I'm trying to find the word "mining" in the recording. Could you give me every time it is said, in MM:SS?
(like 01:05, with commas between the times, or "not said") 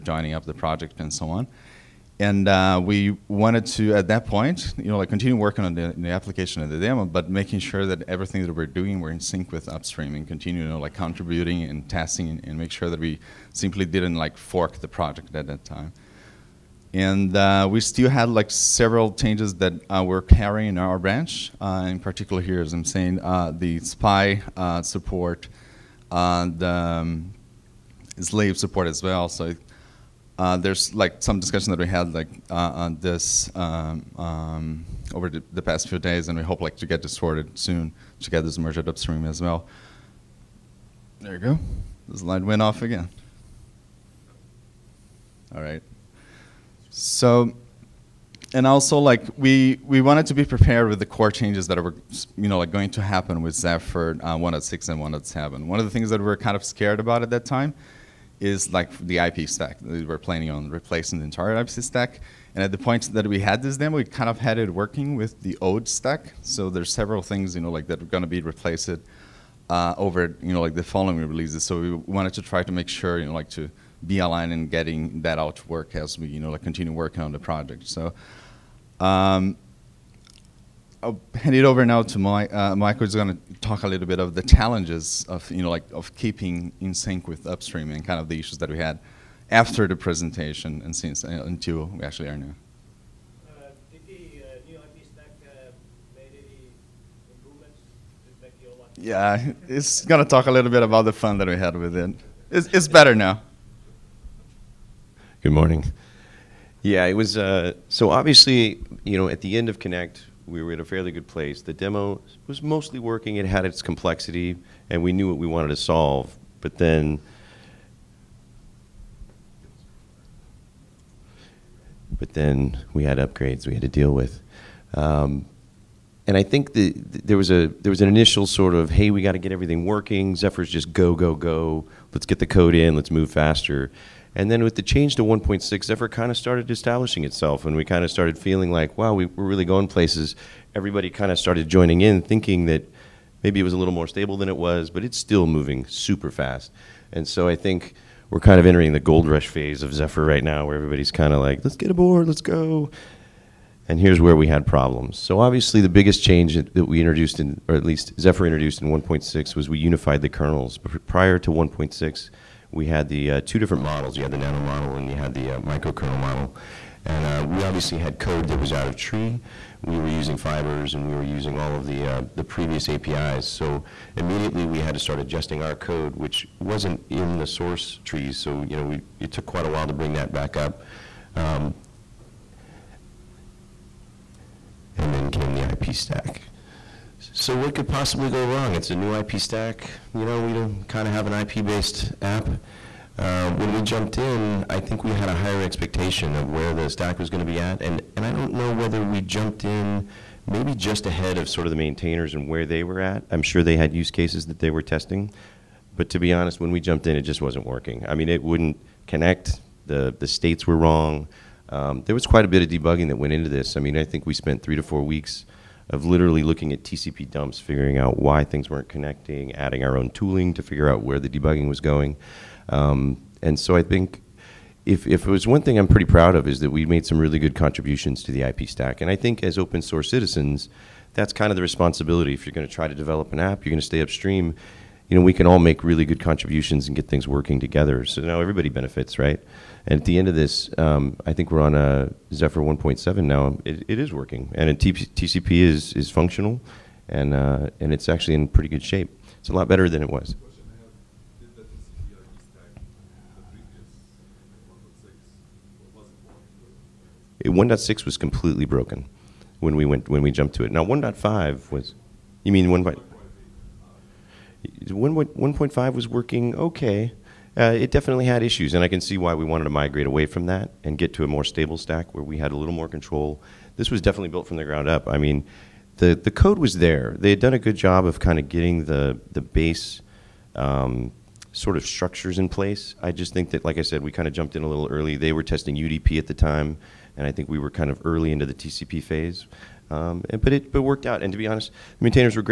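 not said.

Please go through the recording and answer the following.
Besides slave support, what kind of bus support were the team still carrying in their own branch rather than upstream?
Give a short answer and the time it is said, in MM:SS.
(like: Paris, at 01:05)
SPI, at 00:23.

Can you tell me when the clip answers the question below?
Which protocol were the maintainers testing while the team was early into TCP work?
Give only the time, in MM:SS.
04:45.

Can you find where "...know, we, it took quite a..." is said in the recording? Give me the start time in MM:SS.
02:58.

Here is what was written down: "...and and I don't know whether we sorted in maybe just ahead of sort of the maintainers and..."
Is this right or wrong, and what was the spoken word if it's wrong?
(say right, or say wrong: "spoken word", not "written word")
wrong: "jumped", not "sorted".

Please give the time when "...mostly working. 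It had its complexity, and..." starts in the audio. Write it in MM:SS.
01:52.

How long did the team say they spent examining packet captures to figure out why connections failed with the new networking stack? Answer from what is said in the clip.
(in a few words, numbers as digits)
3 to 4 weeks.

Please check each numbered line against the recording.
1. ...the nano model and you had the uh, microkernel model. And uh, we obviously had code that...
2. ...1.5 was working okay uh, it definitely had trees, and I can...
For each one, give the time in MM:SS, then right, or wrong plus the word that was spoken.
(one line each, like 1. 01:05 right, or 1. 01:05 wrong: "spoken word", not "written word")
1. 02:44 right
2. 04:24 wrong: "issues", not "trees".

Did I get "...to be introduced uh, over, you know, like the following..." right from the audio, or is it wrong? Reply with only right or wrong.
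wrong.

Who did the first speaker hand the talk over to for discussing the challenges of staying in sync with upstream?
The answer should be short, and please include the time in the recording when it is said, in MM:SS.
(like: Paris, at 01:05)
Mike, at 01:22.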